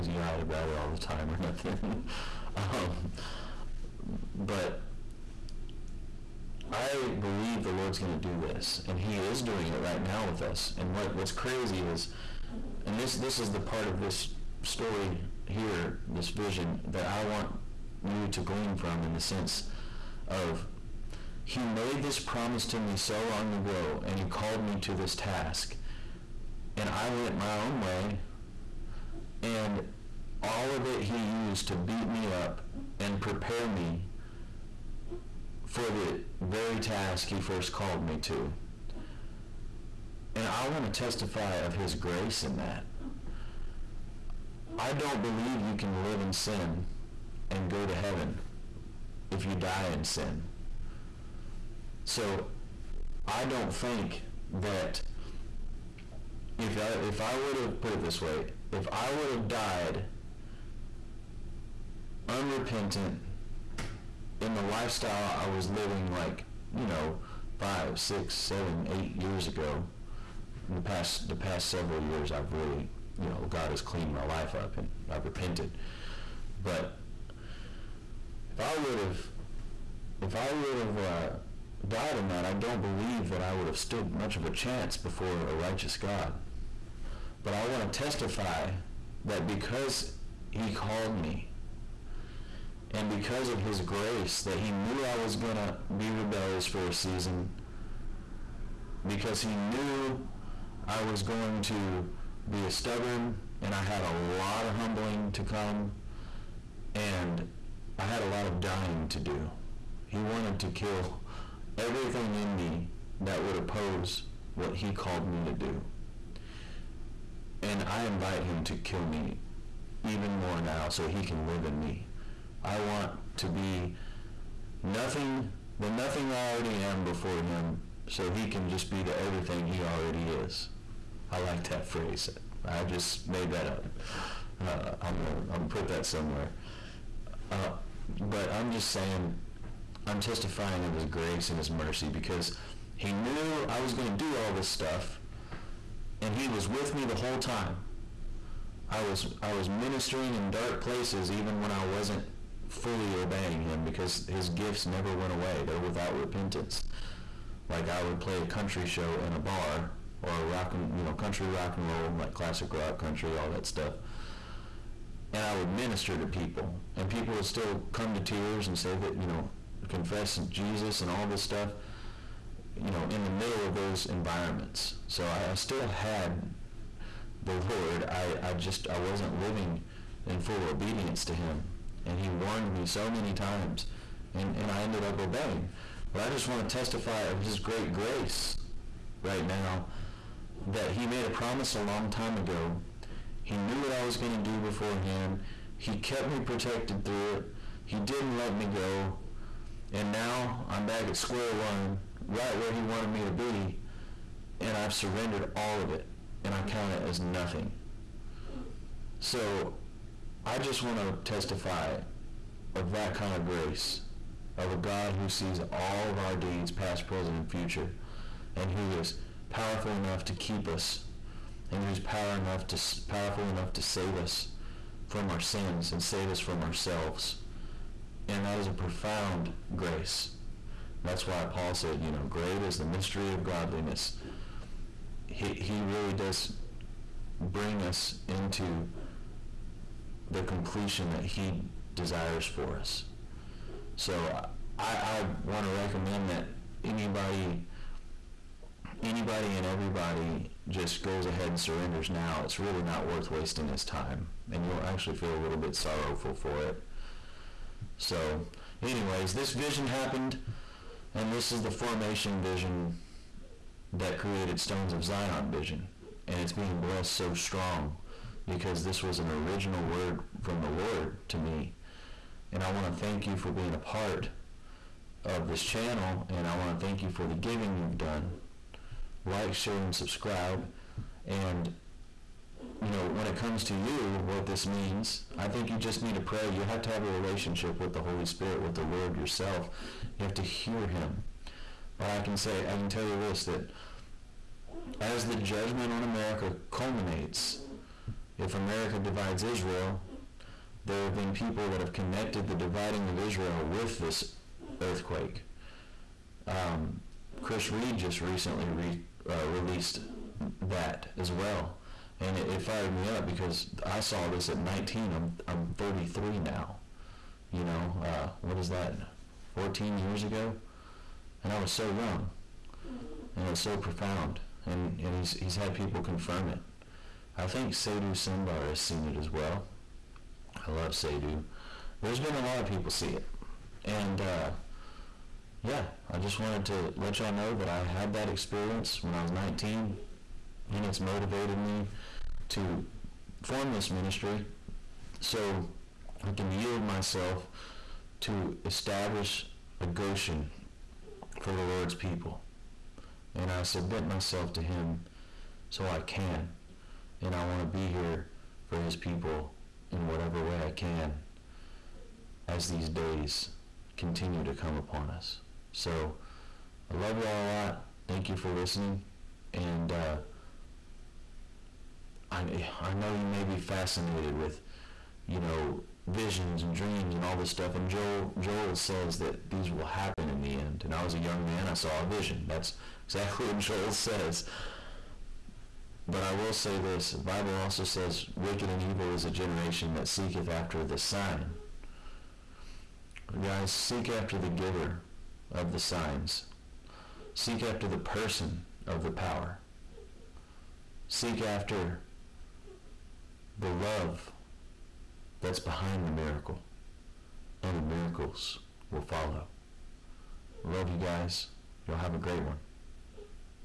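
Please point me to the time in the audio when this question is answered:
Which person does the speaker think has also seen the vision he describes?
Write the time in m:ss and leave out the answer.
5:27.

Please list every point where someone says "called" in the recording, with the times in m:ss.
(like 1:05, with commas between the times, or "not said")
0:24, 0:37, 1:30, 1:54.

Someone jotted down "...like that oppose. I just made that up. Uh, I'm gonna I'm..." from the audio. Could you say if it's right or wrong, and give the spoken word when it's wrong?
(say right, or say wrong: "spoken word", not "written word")
wrong: "phrase", not "oppose".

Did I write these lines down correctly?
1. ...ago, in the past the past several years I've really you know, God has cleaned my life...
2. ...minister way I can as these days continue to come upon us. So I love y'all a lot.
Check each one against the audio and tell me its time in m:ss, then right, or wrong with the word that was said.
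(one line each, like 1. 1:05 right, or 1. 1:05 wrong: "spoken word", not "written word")
1. 1:09 right
2. 6:00 wrong: "whatever", not "minister".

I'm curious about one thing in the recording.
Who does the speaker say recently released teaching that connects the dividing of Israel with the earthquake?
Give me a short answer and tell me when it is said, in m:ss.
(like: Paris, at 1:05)
Chris Reed, at 5:07.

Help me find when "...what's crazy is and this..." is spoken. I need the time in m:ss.
0:11.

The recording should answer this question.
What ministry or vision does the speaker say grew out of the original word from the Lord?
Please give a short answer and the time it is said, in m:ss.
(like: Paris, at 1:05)
Stones of Zion, at 4:24.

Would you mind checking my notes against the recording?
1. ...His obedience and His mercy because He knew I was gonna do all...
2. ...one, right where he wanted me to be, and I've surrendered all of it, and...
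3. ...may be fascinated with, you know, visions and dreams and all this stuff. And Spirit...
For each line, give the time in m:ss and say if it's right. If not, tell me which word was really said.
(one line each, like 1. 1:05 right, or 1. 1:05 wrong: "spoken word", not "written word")
1. 2:20 wrong: "grace", not "obedience"
2. 3:21 right
3. 6:13 wrong: "Joel", not "Spirit".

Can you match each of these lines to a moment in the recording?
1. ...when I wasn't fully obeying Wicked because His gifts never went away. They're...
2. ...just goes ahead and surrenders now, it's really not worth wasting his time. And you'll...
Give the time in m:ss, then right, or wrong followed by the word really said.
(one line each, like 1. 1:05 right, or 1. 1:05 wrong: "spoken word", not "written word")
1. 2:31 wrong: "Him", not "Wicked"
2. 4:10 right.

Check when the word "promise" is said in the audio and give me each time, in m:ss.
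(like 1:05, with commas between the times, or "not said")
0:22, 3:11.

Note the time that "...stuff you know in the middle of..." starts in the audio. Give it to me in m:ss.
2:51.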